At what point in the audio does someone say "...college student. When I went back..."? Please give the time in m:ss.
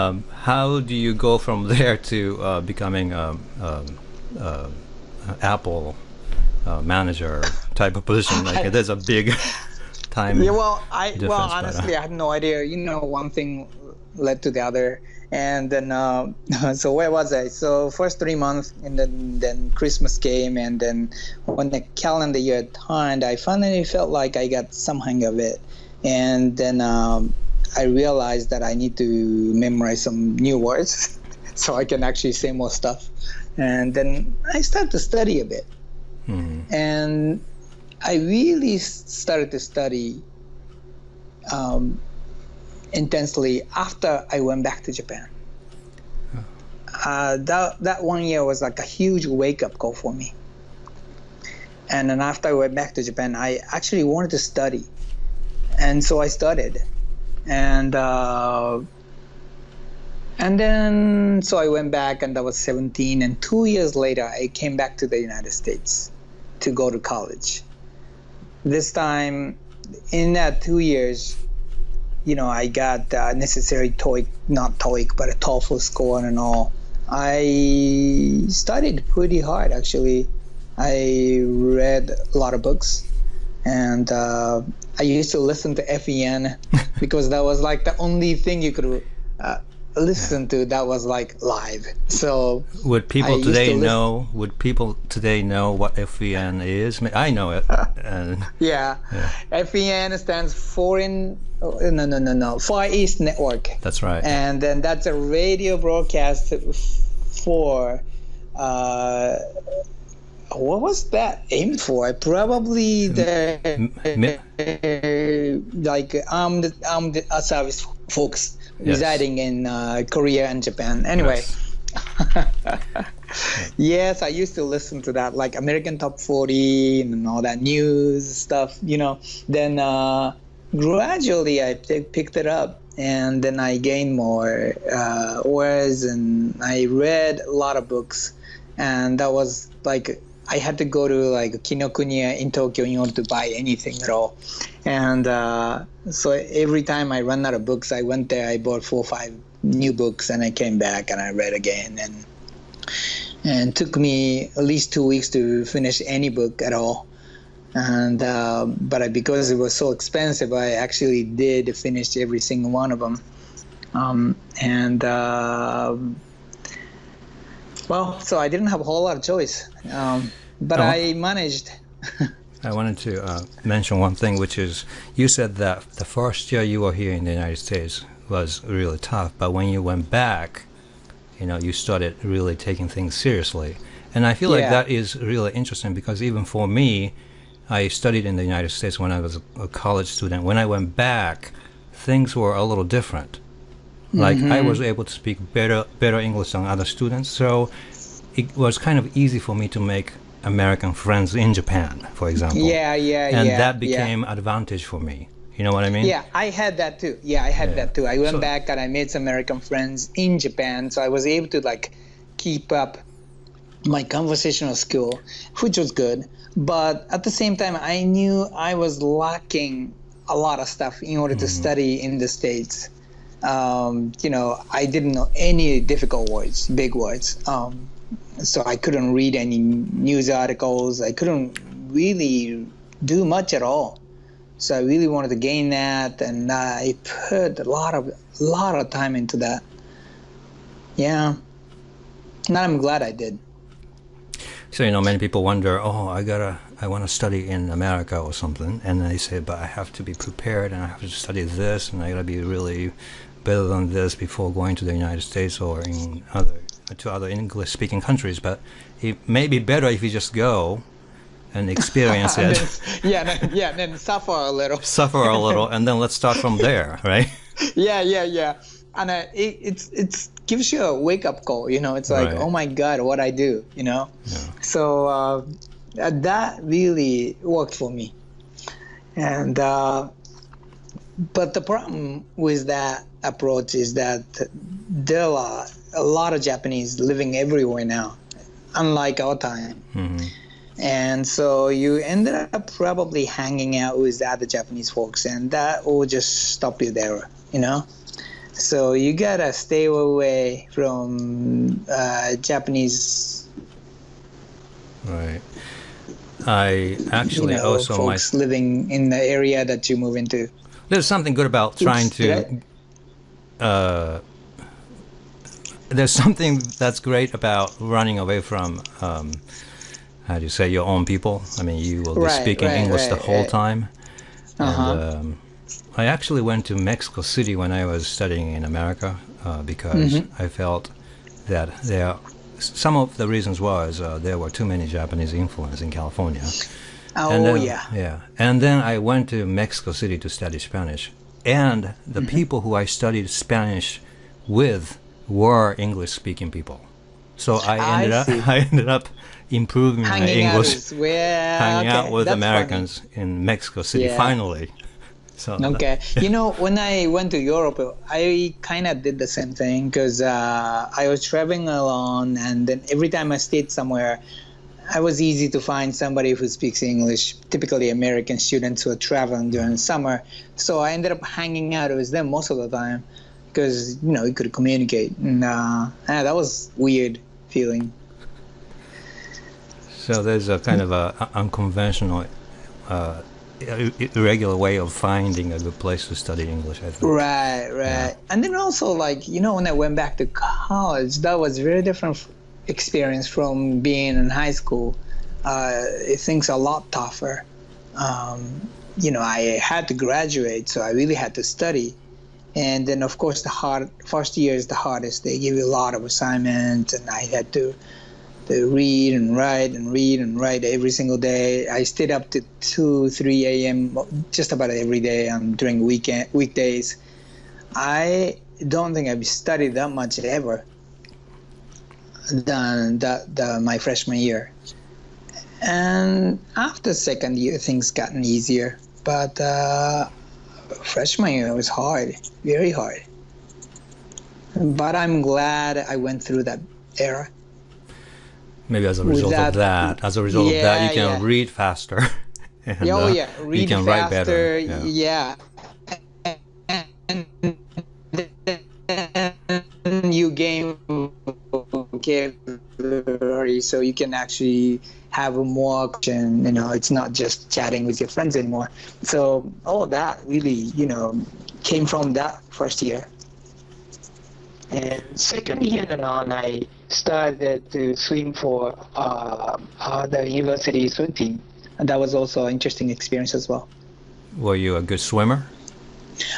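3:09.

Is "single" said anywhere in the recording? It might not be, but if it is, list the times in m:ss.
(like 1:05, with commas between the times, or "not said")
2:42, 6:50.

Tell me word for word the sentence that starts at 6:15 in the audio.
And uh, that was weird feeling.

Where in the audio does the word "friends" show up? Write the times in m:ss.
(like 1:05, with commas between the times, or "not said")
3:20, 3:29, 7:38.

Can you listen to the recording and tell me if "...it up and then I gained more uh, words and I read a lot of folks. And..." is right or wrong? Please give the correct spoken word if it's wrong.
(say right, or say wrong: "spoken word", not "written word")
wrong: "books", not "folks".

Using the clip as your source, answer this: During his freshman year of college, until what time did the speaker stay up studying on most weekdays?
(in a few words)
2 or 3 a.m.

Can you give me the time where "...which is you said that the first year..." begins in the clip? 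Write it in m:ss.
2:54.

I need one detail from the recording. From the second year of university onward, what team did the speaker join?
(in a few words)
university swim team.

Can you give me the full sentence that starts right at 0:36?
and I really started to study.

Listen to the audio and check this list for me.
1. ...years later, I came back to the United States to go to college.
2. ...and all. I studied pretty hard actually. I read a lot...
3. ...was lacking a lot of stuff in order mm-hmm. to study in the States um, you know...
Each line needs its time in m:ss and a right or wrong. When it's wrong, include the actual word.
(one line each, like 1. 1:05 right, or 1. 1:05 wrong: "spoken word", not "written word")
1. 1:03 right
2. 1:16 right
3. 3:38 right.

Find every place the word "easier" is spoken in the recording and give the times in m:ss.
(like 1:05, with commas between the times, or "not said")
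7:08.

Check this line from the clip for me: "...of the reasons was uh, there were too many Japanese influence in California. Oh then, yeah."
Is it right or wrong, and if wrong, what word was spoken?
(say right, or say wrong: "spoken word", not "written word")
right.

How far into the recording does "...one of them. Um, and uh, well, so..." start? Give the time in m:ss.
2:42.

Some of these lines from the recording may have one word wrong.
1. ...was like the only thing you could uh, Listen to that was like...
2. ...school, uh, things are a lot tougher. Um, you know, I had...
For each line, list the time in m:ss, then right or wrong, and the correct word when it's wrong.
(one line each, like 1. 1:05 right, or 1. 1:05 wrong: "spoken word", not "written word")
1. 1:27 right
2. 6:34 right.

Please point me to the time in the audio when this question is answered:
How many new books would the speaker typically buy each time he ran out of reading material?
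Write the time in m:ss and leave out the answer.
2:28.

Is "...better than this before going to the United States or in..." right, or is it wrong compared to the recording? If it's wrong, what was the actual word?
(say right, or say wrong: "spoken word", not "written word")
right.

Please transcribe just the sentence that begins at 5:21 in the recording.
I mean, you will be right, speaking right, English right, the whole time.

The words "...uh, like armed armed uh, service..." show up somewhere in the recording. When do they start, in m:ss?
1:55.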